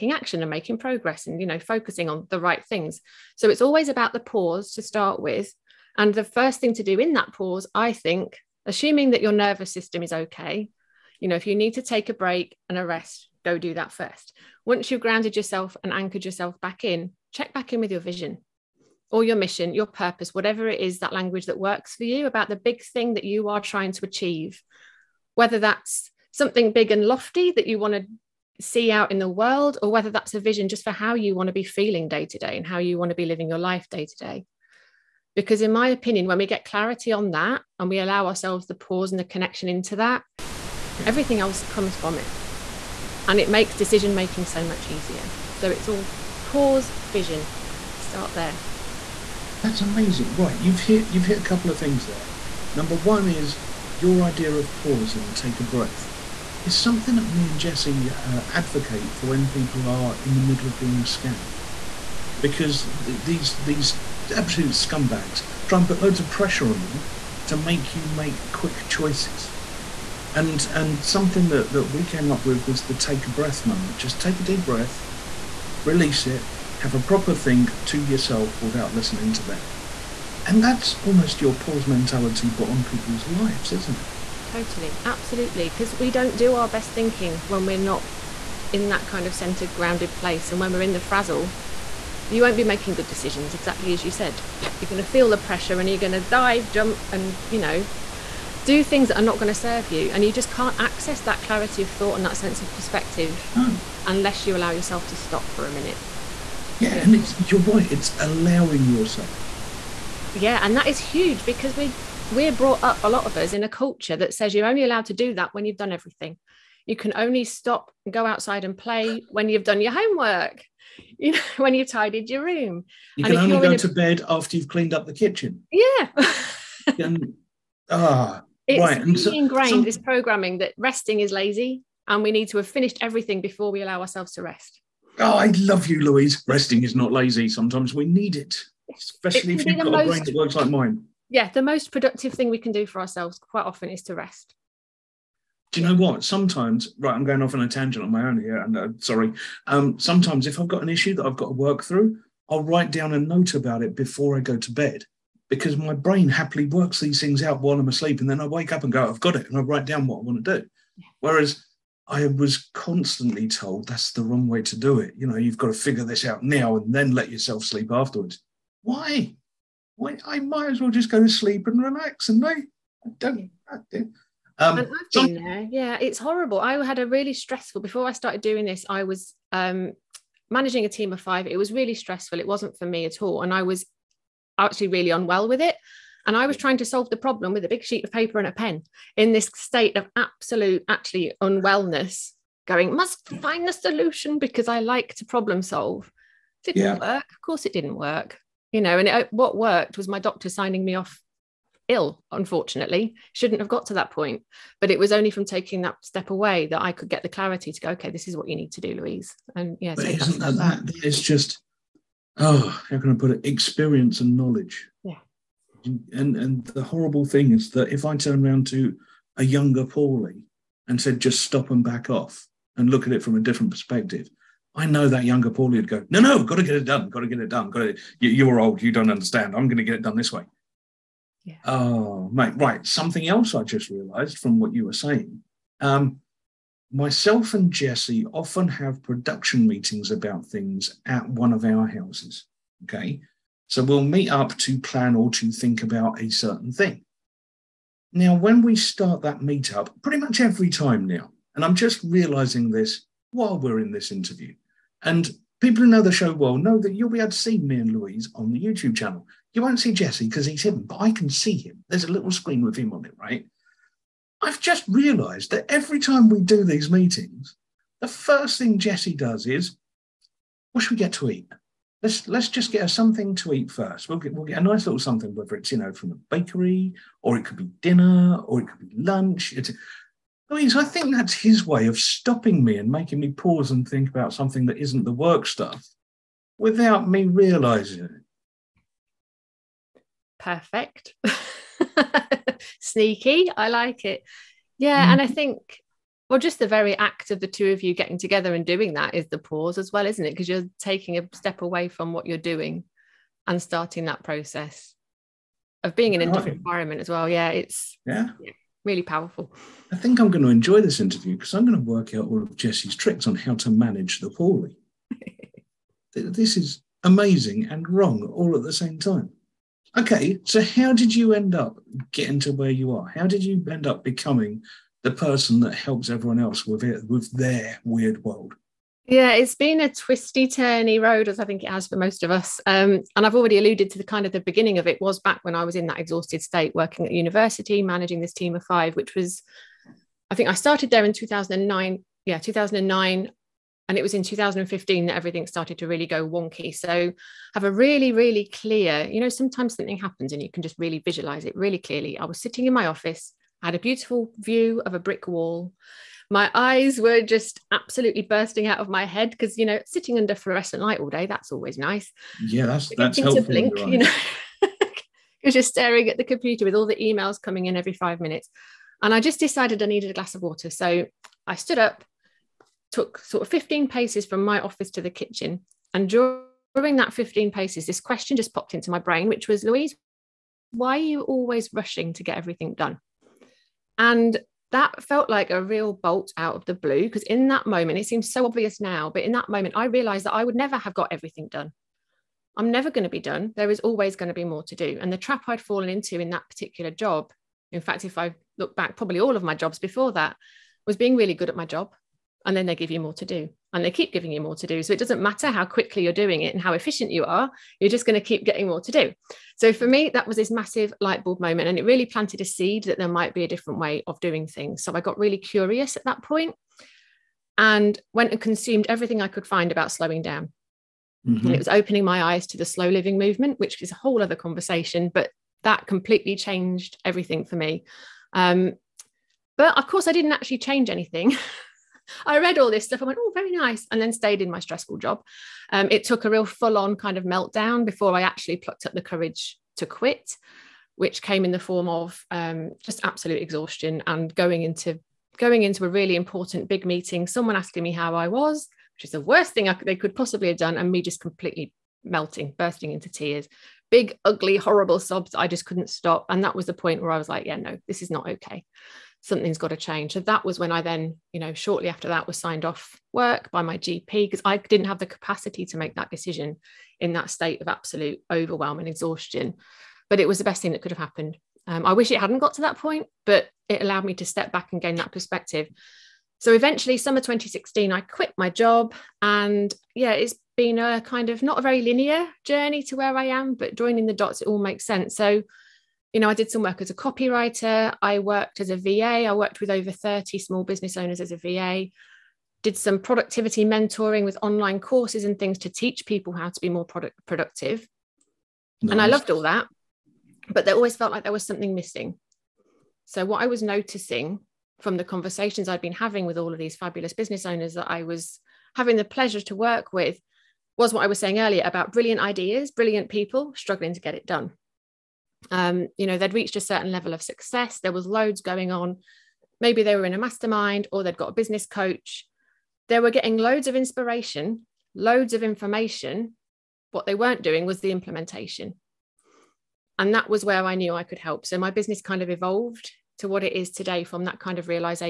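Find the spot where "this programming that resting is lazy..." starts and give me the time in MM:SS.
02:09.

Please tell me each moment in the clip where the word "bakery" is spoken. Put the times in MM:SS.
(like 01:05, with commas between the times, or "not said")
04:36.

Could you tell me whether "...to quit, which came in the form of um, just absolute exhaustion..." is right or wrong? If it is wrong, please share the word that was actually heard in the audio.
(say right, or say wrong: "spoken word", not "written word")
right.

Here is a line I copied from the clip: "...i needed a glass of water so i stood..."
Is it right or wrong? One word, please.
right.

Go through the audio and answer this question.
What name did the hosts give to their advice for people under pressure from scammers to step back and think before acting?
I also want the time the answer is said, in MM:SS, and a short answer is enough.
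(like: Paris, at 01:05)
take a breath moment, at 01:12.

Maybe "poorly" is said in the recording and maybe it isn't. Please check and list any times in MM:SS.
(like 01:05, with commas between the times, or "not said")
05:14.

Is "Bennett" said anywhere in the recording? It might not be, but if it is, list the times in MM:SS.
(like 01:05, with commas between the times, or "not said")
not said.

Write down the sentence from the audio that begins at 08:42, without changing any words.
They were getting loads of inspiration, loads of information.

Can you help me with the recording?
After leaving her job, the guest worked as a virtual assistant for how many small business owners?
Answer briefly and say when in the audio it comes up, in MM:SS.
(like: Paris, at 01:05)
over 30, at 08:09.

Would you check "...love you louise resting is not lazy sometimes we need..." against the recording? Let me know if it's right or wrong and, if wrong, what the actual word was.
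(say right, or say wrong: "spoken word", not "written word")
right.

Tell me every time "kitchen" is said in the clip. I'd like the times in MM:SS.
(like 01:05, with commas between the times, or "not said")
02:05, 06:15.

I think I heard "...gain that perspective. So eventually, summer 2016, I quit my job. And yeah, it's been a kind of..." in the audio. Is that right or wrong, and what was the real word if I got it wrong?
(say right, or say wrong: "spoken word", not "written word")
right.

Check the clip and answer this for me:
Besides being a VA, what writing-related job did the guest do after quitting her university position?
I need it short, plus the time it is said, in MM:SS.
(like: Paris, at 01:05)
copywriter, at 08:06.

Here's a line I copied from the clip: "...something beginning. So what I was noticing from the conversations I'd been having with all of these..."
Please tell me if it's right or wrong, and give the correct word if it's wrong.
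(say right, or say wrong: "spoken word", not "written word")
wrong: "missing", not "beginning".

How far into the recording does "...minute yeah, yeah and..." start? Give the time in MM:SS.
01:45.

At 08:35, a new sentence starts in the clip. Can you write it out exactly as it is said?
Um, you know, they'd reached a certain level of success, there was loads going on.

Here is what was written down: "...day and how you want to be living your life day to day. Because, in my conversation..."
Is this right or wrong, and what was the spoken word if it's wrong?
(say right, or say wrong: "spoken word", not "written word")
wrong: "opinion", not "conversation".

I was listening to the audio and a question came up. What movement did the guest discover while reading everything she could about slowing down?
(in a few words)
slow living movement.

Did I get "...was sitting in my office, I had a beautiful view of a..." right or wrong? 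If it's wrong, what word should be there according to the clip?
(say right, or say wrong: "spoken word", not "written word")
right.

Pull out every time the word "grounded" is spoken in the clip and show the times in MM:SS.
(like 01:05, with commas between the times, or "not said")
00:15, 01:29.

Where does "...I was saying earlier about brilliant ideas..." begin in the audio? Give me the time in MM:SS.
08:31.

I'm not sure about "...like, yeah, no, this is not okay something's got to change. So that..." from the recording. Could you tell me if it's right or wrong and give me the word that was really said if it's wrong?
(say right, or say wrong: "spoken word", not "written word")
right.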